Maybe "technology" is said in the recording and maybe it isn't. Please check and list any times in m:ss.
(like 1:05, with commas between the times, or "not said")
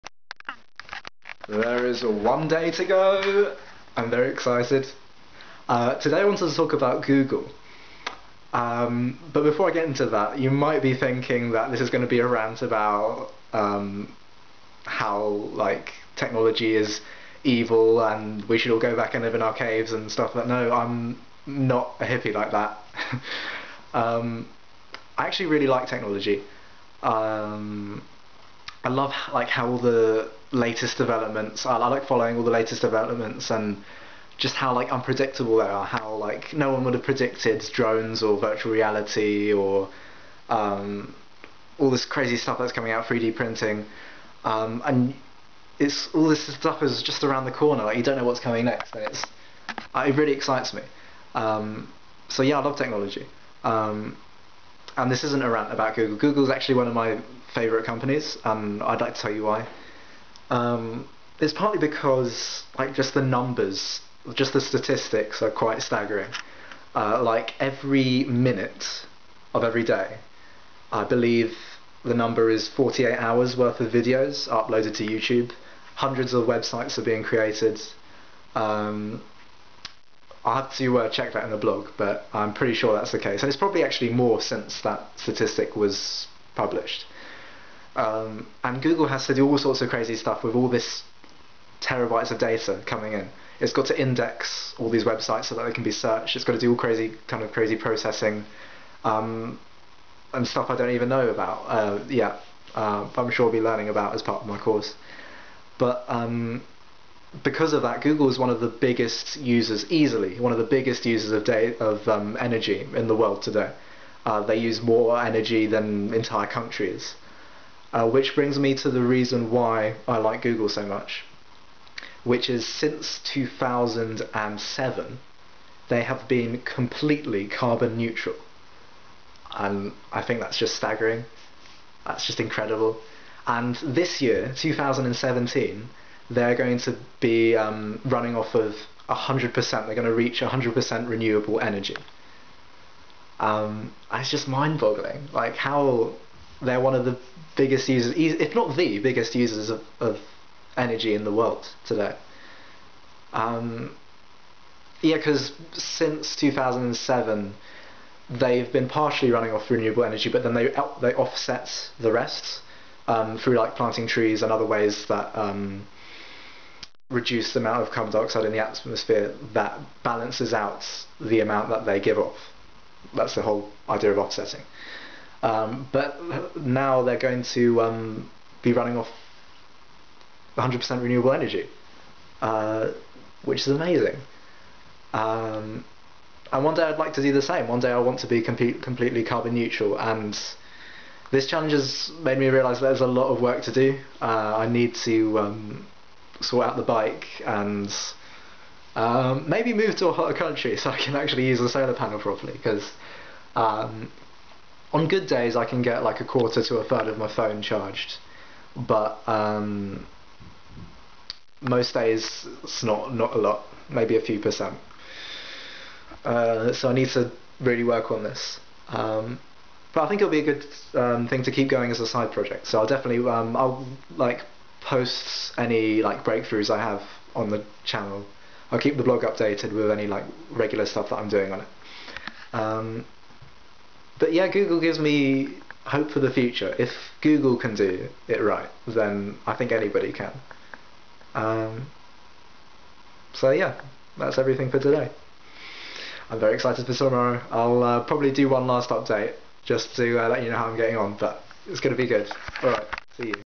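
0:16, 0:25, 0:52.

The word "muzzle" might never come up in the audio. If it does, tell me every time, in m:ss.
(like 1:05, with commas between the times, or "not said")
not said.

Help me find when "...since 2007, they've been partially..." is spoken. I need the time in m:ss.
2:35.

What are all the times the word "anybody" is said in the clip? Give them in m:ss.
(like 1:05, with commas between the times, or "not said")
3:59.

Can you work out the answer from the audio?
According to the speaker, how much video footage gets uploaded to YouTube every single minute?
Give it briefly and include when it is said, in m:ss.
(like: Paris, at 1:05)
48 hours, at 1:12.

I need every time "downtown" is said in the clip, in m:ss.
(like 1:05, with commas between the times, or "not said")
not said.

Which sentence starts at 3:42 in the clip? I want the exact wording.
So I'll definitely um, I'll like post any like breakthroughs I have on the channel.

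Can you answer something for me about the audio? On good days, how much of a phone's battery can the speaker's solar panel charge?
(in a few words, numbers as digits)
a quarter to a third.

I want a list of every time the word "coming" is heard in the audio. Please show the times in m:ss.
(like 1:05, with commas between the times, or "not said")
0:42, 0:48, 1:32.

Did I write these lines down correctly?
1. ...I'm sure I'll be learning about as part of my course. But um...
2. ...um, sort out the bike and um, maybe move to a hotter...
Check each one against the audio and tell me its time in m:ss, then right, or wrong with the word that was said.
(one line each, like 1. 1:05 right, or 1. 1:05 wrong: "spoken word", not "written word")
1. 1:43 right
2. 3:15 right.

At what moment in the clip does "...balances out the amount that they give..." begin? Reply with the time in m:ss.
2:50.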